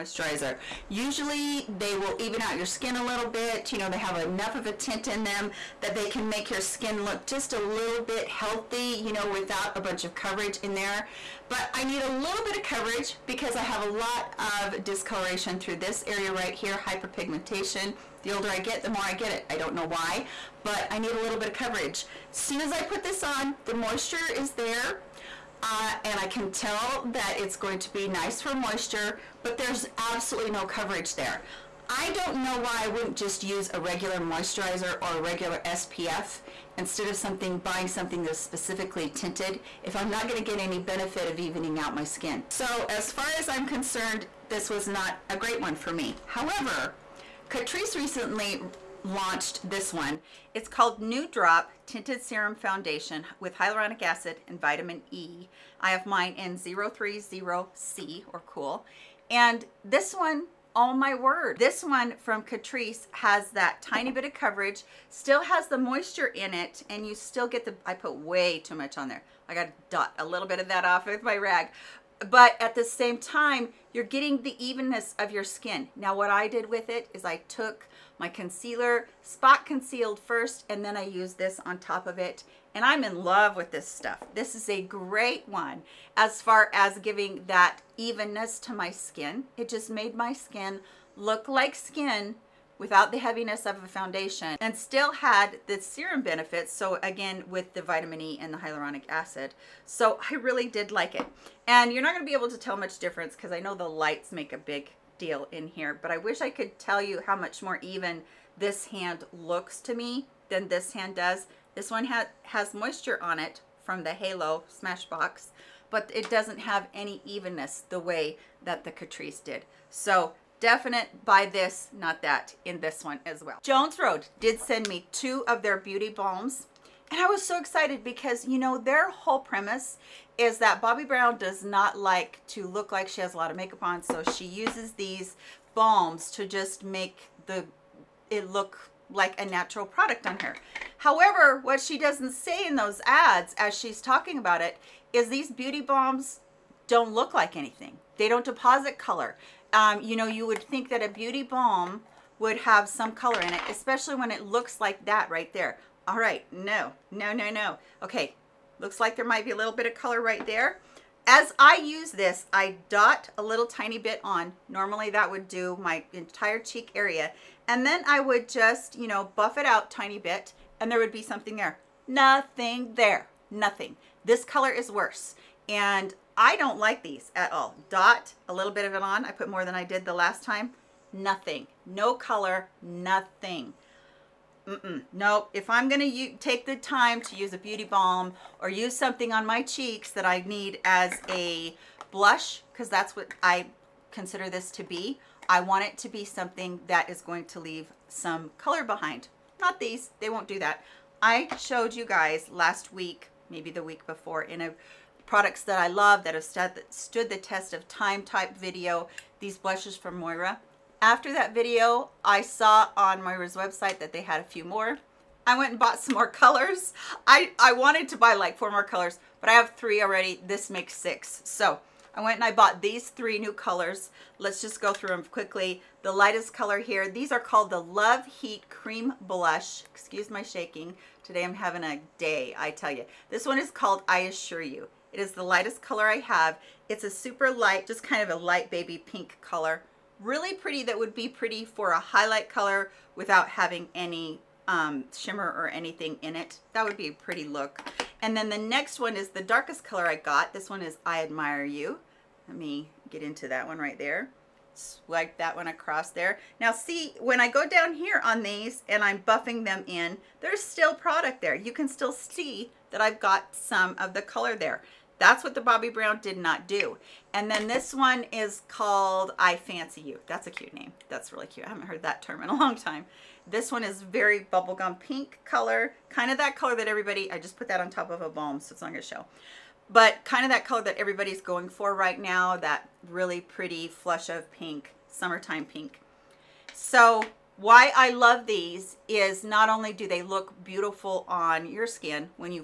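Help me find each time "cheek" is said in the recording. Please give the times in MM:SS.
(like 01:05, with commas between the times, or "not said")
02:46, 03:09.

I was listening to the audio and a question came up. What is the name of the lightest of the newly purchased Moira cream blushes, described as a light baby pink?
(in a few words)
I Assure You.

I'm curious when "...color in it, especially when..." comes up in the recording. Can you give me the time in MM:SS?
02:33.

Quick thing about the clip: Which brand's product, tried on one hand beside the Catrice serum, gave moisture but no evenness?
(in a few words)
Halo Smashbox.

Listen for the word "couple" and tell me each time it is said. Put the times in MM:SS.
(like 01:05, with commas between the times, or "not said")
not said.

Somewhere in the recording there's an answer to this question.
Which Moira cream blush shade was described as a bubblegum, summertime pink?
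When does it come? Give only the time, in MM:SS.
04:29.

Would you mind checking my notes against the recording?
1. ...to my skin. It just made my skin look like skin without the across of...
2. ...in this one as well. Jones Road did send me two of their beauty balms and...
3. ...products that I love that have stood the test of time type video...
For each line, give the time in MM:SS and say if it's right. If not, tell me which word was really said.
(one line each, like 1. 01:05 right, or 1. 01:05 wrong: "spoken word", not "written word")
1. 01:28 wrong: "heaviness", not "across"
2. 02:02 right
3. 03:25 right.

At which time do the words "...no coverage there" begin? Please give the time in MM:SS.
00:30.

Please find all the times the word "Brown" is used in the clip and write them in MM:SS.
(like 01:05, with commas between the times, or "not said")
02:11, 04:25.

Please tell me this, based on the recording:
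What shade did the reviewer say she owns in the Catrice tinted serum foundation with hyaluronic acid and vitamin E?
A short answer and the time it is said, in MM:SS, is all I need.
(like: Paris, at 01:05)
030C, at 00:56.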